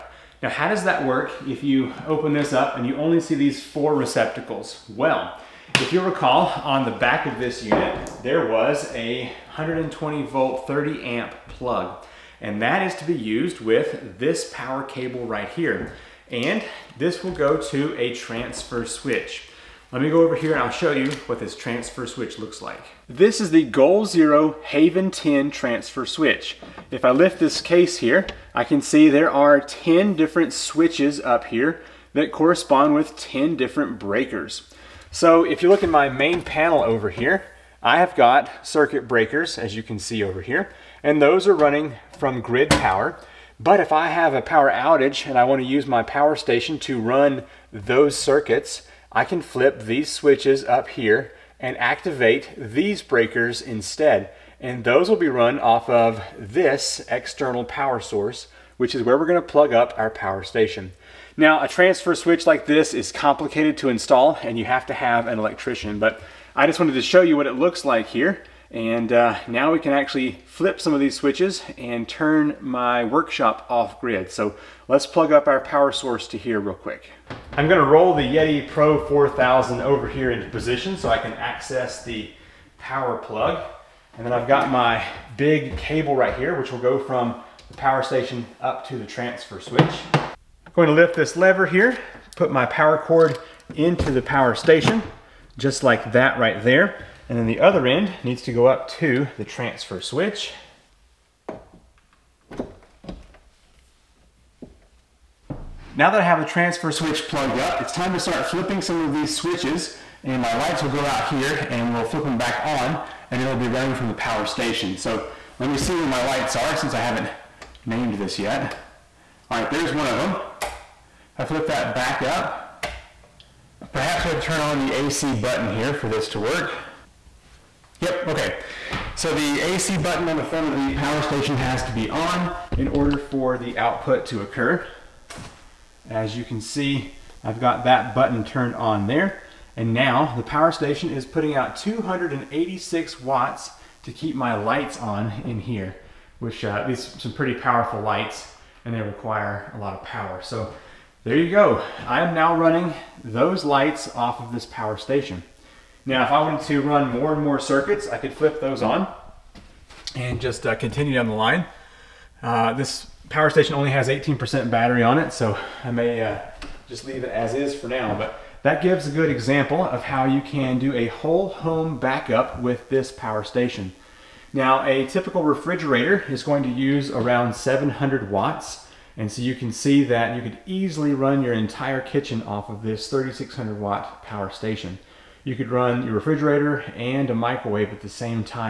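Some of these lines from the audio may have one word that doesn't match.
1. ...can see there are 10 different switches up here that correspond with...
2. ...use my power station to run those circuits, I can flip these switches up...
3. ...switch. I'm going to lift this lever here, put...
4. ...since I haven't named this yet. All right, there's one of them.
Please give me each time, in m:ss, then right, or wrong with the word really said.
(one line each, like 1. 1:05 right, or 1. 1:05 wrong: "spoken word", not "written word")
1. 0:28 right
2. 0:45 right
3. 1:29 right
4. 1:56 right.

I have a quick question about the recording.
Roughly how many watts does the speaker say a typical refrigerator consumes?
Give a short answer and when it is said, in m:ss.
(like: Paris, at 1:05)
700 watts, at 2:57.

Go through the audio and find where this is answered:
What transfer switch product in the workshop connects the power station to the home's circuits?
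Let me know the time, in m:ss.
0:23.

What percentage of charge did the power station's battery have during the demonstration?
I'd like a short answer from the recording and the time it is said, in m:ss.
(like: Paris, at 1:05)
18%, at 2:44.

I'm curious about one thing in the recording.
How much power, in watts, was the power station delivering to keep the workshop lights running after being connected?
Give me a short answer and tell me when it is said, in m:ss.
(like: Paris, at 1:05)
286 watts, at 2:21.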